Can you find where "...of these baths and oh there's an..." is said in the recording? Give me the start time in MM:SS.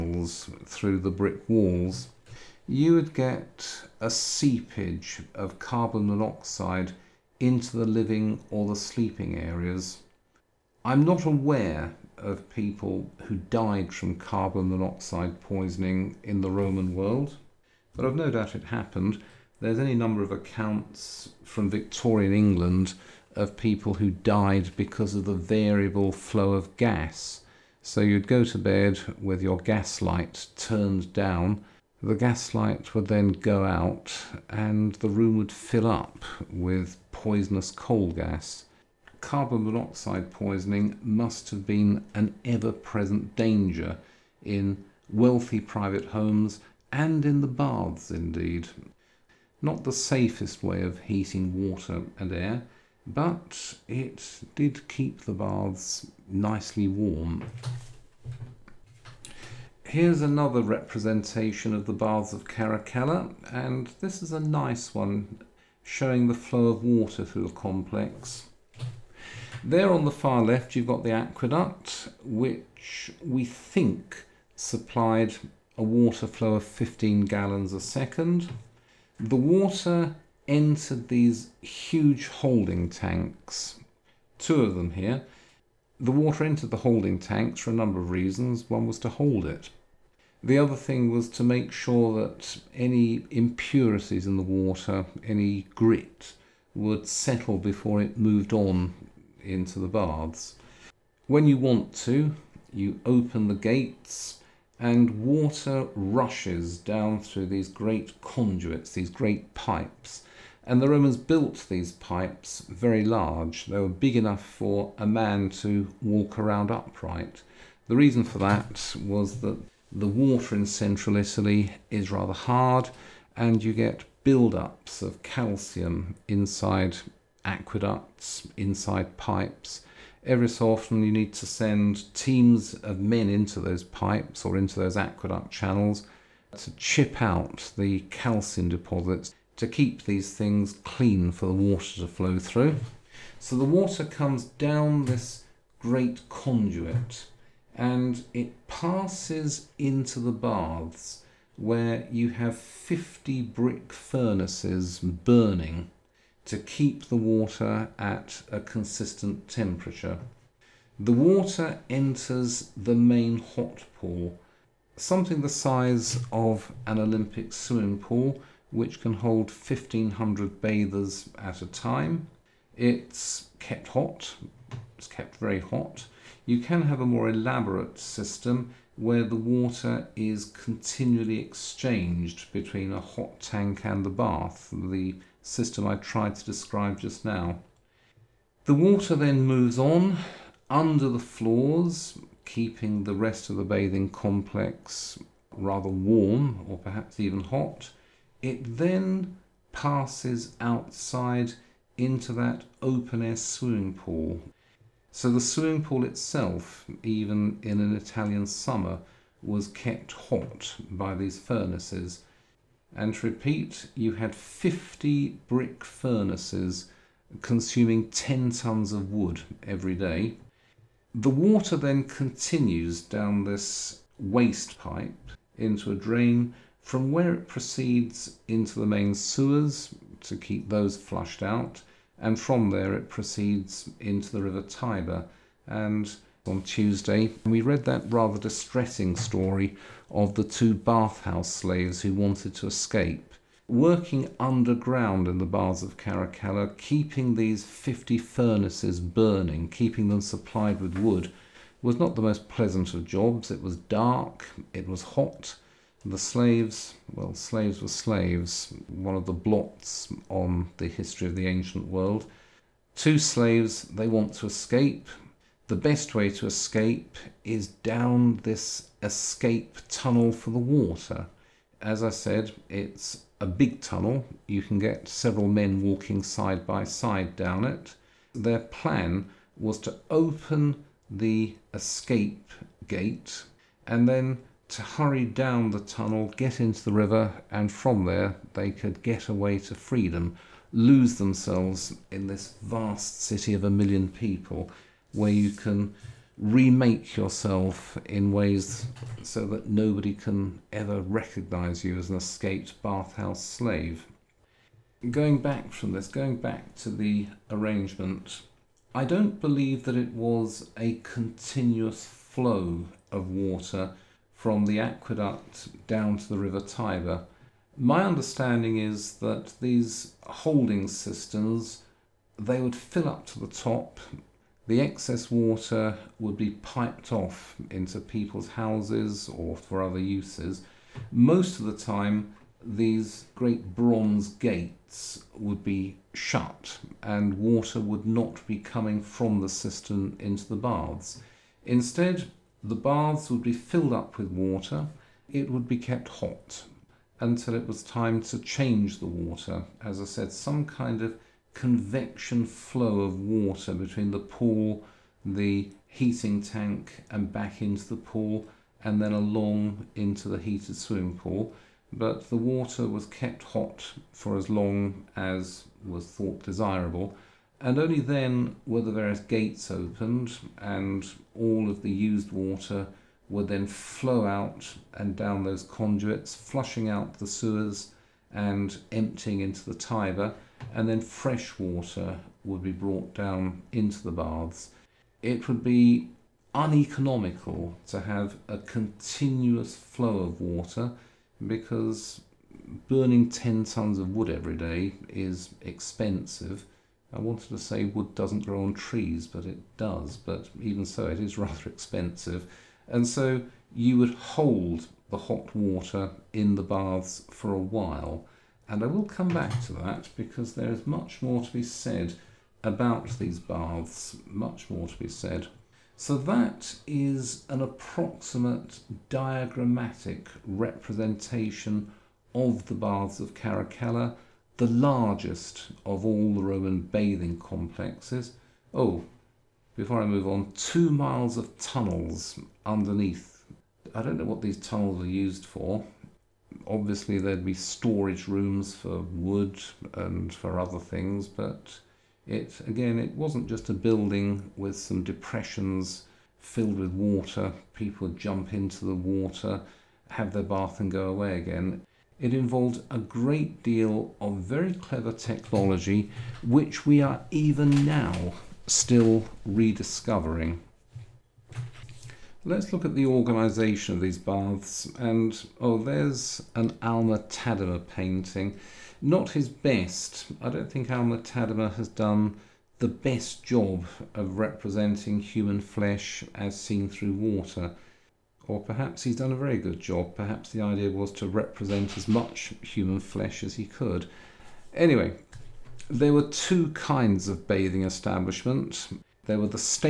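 07:43.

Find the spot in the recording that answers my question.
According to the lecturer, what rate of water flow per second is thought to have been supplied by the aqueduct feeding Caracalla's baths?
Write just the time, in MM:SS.
01:16.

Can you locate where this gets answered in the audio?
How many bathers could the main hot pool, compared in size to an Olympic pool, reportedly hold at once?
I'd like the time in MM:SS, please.
02:49.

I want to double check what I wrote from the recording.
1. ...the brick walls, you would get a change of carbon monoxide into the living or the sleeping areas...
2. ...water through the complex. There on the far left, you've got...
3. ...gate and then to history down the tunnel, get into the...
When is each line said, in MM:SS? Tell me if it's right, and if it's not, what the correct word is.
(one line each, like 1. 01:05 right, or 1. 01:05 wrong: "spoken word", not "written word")
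1. 00:00 wrong: "seepage", not "change"
2. 01:06 right
3. 04:42 wrong: "hurry", not "history".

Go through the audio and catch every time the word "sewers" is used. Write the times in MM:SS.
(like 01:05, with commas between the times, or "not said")
03:49, 06:17.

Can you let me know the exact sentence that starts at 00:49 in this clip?
Not the safest way of heating water and air, but it did keep the baths nicely warm.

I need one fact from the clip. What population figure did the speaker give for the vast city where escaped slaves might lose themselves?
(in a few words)
a million.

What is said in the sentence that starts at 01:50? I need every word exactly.
And the Romans built these pipes very large.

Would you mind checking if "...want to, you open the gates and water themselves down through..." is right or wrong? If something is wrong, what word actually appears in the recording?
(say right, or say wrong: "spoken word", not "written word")
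wrong: "rushes", not "themselves".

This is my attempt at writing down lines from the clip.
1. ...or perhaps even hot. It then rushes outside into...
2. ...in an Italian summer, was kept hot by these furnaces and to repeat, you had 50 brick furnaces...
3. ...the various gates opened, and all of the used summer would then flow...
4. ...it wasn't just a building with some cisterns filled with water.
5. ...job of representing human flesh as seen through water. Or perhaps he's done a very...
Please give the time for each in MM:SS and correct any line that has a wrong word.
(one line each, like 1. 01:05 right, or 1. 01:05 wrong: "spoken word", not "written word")
1. 03:16 wrong: "passes", not "rushes"
2. 03:27 right
3. 06:08 wrong: "water", not "summer"
4. 07:22 wrong: "depressions", not "cisterns"
5. 07:53 right.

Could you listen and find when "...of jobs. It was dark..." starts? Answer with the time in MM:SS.
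04:12.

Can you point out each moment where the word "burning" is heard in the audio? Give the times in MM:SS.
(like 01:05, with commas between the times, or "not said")
02:34, 04:08, 06:32.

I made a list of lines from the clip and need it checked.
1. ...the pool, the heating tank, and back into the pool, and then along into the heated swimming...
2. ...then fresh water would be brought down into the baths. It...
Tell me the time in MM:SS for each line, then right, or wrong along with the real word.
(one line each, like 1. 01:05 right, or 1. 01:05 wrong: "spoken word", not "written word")
1. 05:54 right
2. 06:20 right.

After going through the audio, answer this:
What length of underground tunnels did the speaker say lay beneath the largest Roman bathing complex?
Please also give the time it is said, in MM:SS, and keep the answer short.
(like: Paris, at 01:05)
two miles, at 07:10.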